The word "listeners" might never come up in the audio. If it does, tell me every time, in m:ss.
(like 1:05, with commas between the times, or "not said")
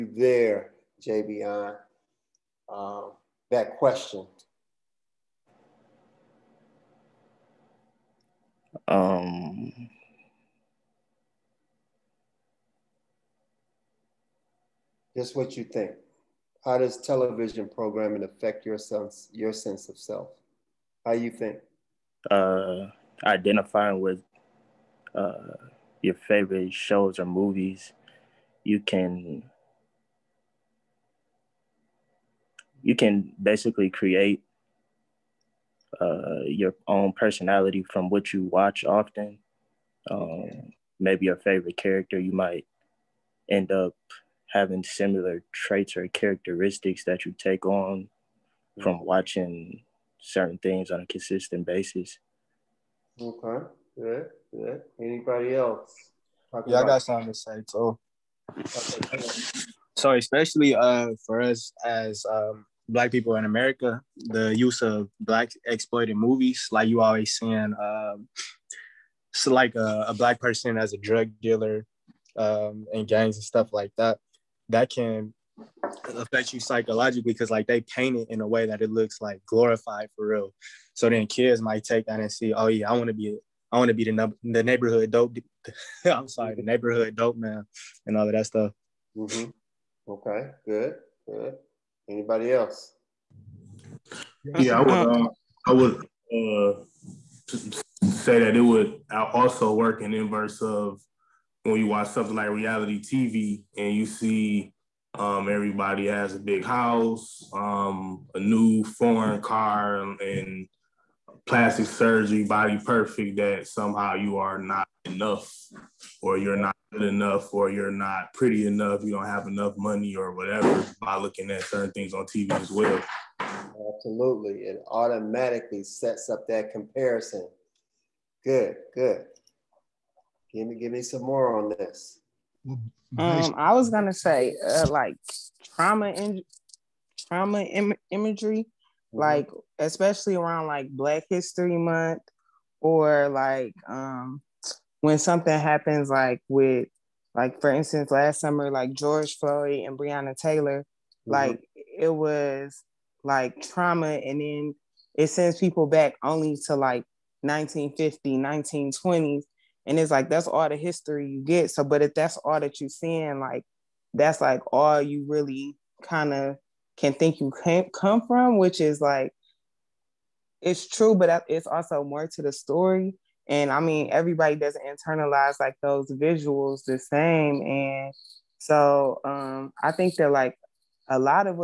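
not said.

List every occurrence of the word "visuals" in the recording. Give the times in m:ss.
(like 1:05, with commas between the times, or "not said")
2:56.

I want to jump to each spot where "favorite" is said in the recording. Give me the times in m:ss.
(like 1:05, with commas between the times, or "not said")
0:26, 0:41.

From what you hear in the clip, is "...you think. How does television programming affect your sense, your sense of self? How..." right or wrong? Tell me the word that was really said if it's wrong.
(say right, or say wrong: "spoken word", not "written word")
right.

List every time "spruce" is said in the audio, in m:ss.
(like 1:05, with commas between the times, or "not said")
not said.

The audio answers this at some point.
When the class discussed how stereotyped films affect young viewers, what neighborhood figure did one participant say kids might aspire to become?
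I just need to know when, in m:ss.
1:26.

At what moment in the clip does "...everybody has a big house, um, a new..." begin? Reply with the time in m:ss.
1:45.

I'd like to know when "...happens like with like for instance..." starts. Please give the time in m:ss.
2:25.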